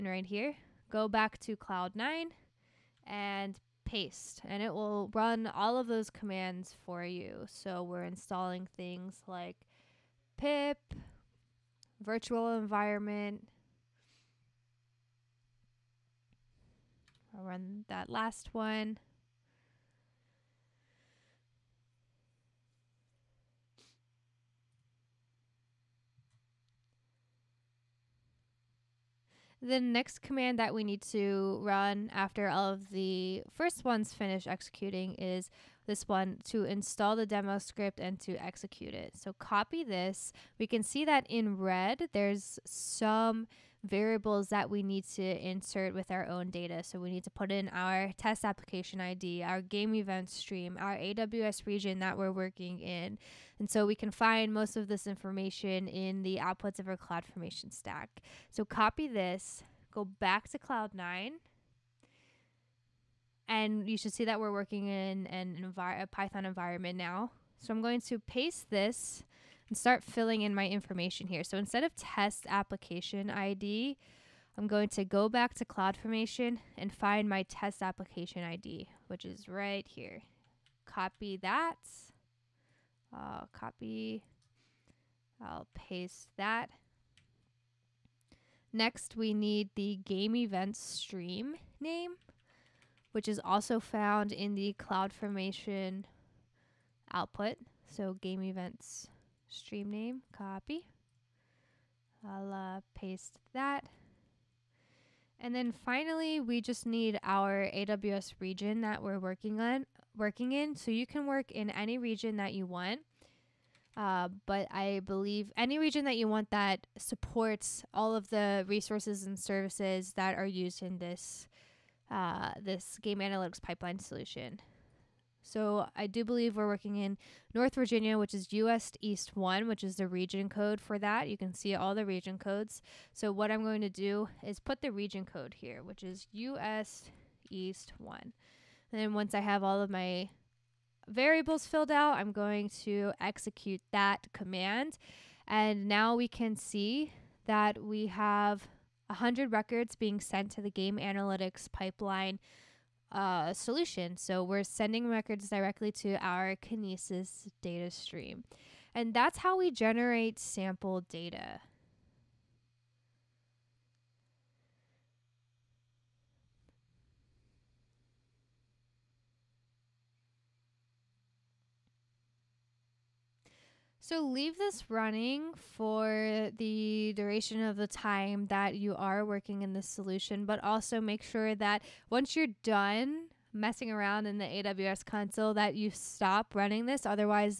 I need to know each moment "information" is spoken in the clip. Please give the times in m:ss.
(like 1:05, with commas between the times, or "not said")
0:55, 1:10.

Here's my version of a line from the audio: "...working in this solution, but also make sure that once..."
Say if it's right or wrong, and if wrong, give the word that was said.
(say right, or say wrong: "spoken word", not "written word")
right.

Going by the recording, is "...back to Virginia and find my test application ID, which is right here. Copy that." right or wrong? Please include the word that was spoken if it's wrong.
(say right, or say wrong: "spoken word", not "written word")
wrong: "CloudFormation", not "Virginia".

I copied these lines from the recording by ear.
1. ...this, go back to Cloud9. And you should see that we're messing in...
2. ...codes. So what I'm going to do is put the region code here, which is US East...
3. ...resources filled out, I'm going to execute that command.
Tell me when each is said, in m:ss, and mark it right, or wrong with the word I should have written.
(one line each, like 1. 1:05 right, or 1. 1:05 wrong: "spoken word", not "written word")
1. 0:59 wrong: "working", not "messing"
2. 2:12 right
3. 2:21 wrong: "variables", not "resources".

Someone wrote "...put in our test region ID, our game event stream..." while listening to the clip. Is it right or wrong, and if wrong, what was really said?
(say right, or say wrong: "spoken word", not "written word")
wrong: "application", not "region".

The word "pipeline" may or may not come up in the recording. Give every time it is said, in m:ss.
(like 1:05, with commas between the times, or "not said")
2:03, 2:31.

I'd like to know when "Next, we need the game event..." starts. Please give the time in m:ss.
1:28.